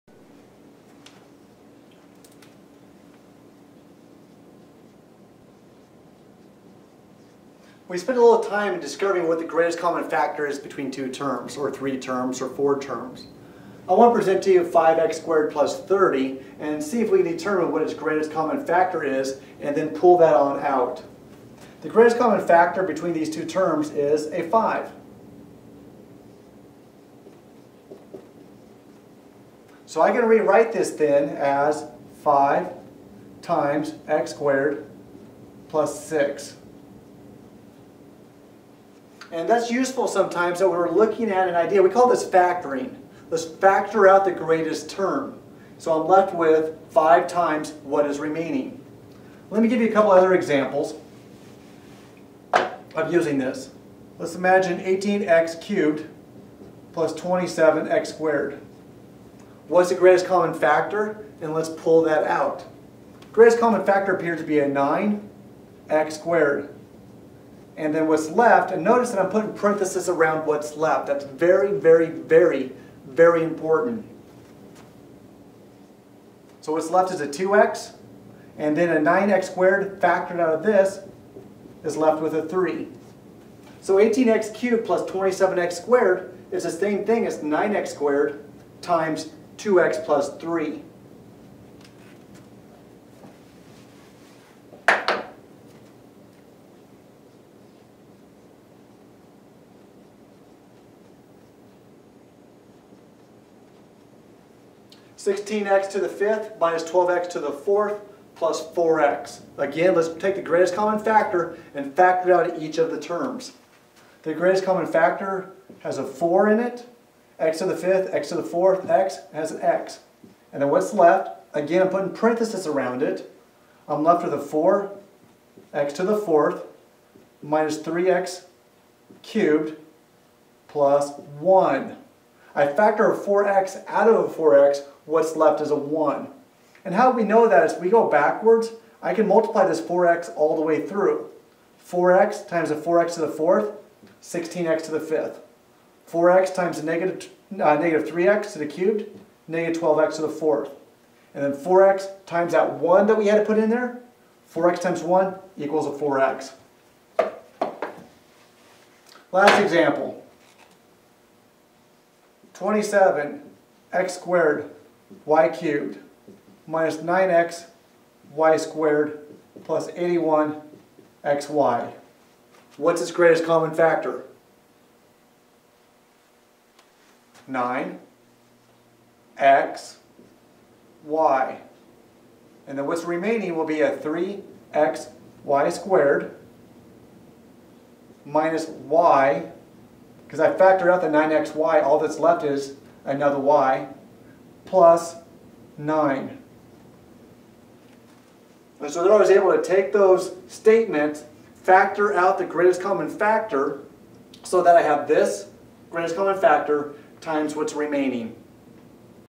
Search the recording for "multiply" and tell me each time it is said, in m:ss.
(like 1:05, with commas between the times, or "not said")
2:19.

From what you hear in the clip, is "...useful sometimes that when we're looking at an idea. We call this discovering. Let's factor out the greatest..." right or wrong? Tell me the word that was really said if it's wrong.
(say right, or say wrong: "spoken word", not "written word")
wrong: "factoring", not "discovering".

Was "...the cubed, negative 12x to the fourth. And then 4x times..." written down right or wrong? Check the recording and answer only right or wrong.
right.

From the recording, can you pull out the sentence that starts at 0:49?
Let me give you a couple other examples of using this.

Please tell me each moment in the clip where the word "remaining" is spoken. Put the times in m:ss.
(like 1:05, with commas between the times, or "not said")
0:48, 3:03, 3:27.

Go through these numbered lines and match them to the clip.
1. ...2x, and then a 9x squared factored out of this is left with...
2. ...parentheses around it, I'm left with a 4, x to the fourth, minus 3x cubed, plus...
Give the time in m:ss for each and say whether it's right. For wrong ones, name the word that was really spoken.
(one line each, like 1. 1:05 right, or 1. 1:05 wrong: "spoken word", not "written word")
1. 1:17 right
2. 2:02 right.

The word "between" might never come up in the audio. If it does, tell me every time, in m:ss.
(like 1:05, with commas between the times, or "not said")
0:10, 0:22.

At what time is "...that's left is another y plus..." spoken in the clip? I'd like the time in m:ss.
3:11.